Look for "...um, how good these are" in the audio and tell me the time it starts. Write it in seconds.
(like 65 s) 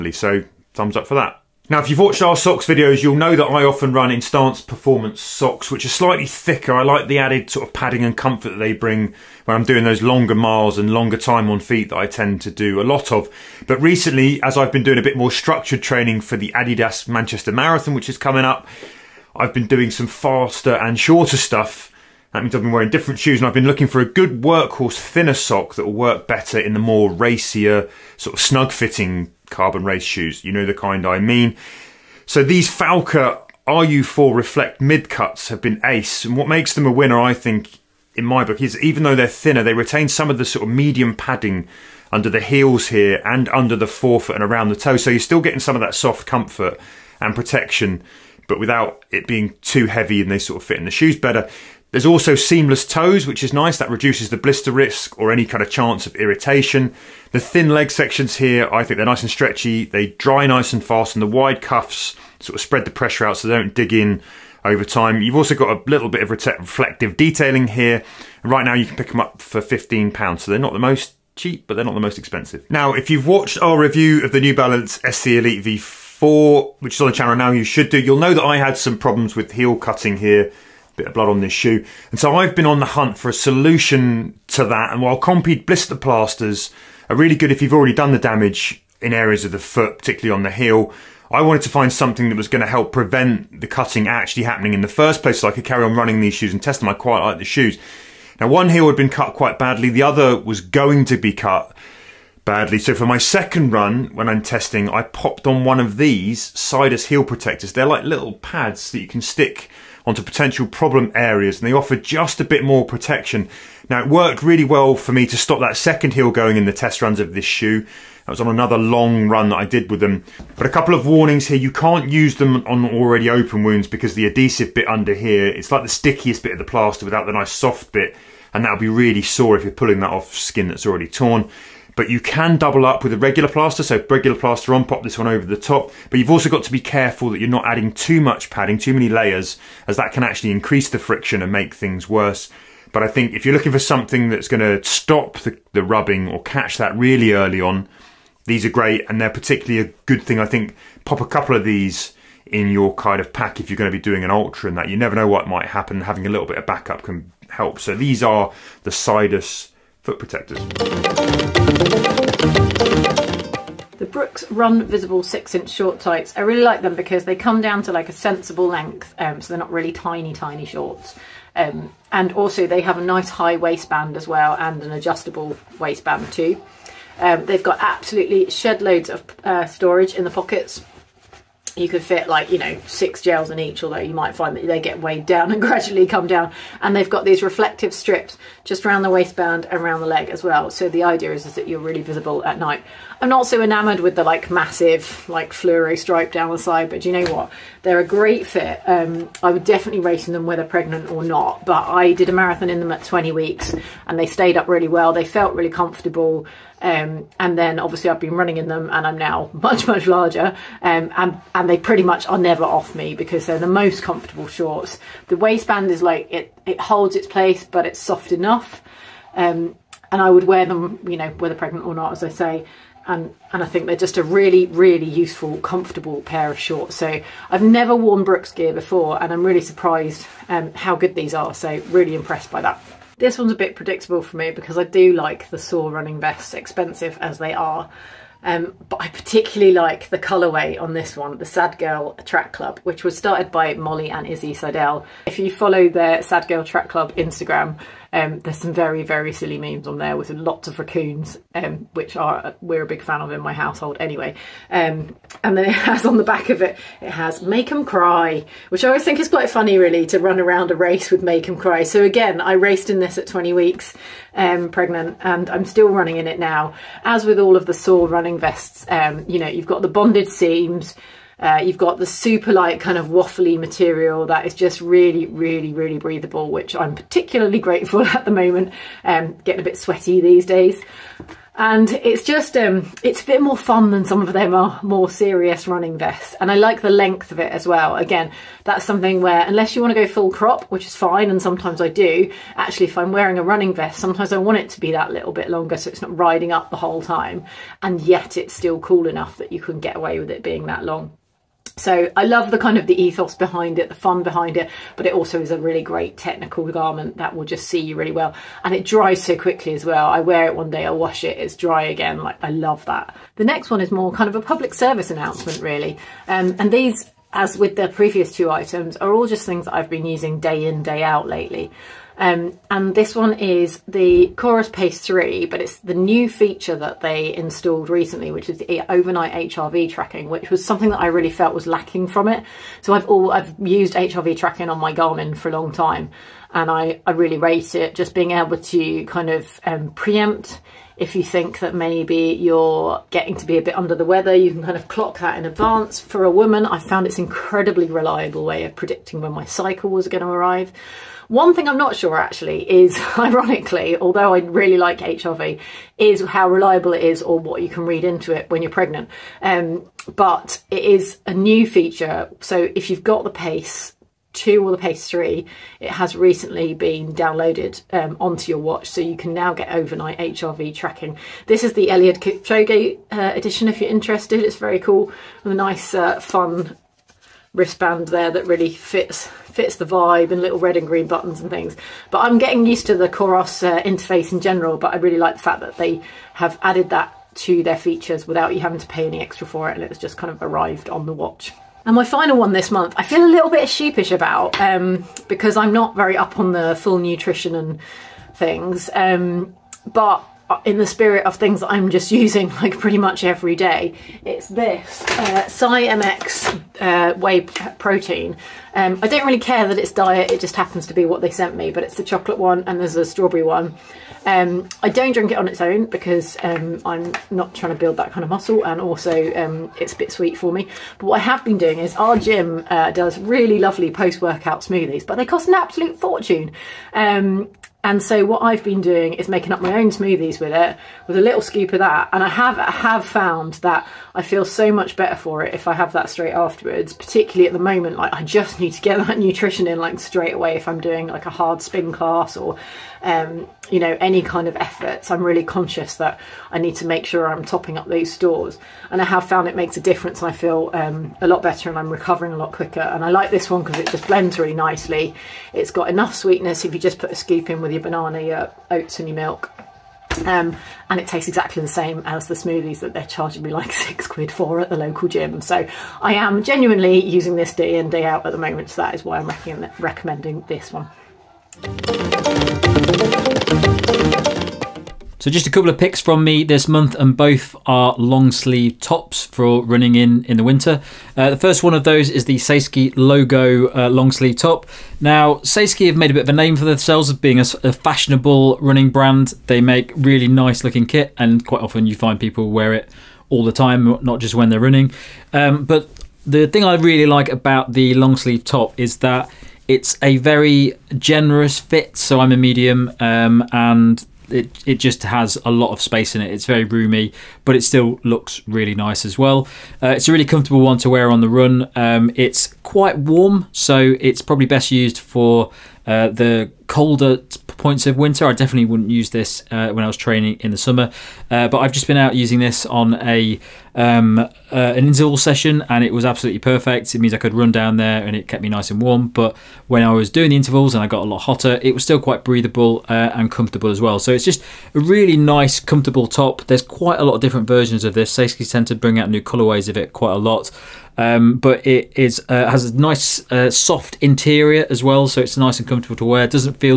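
230 s.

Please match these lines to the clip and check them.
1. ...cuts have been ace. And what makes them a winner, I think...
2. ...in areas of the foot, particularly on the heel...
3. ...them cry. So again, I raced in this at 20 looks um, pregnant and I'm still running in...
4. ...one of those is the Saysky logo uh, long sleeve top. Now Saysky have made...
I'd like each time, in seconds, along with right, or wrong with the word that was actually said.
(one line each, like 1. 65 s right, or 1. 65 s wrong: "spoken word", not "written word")
1. 35 s right
2. 89 s right
3. 261 s wrong: "weeks", not "looks"
4. 481 s right.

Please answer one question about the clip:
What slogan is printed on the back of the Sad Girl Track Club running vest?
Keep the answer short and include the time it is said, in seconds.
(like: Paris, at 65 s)
make them cry, at 257 s.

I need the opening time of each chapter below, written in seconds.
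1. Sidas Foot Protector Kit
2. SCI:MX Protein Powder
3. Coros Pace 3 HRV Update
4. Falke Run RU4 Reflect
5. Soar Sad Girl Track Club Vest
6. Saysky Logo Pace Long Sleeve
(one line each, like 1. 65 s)
1. 108 s
2. 408 s
3. 328 s
4. 34 s
5. 243 s
6. 479 s.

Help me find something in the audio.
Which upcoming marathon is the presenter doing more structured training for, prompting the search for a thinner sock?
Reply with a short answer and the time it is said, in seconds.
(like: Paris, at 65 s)
Adidas Manchester Marathon, at 16 s.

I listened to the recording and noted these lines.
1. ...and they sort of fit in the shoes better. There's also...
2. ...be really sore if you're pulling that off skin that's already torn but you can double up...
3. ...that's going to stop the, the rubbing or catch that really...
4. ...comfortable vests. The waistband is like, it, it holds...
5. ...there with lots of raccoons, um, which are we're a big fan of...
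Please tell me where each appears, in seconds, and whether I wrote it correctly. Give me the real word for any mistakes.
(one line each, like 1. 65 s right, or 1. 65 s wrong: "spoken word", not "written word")
1. 50 s right
2. 128 s right
3. 144 s right
4. 214 s wrong: "shorts", not "vests"
5. 249 s right.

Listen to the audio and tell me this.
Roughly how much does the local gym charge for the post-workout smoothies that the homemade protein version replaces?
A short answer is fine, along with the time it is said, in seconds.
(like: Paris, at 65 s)
six quid, at 463 s.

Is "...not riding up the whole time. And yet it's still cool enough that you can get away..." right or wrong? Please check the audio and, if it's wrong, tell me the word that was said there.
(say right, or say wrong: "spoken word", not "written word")
right.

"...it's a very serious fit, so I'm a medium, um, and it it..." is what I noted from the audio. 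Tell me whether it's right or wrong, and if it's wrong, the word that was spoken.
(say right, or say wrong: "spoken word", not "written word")
wrong: "generous", not "serious".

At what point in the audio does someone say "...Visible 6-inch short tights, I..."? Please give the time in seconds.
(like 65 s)
164 s.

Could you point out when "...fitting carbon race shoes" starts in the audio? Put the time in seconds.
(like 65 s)
28 s.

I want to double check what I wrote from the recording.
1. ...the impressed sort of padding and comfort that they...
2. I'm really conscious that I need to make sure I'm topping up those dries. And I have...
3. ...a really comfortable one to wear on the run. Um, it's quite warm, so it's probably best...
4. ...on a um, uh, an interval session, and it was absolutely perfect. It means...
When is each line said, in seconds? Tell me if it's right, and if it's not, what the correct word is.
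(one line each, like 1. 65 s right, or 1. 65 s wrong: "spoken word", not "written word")
1. 7 s wrong: "added", not "impressed"
2. 445 s wrong: "stores", not "dries"
3. 510 s right
4. 522 s right.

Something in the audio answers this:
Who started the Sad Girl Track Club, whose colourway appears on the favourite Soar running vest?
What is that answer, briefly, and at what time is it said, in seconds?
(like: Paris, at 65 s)
Molly and Izzy Seidel, at 243 s.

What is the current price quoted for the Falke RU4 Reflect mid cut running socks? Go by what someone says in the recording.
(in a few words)
£15.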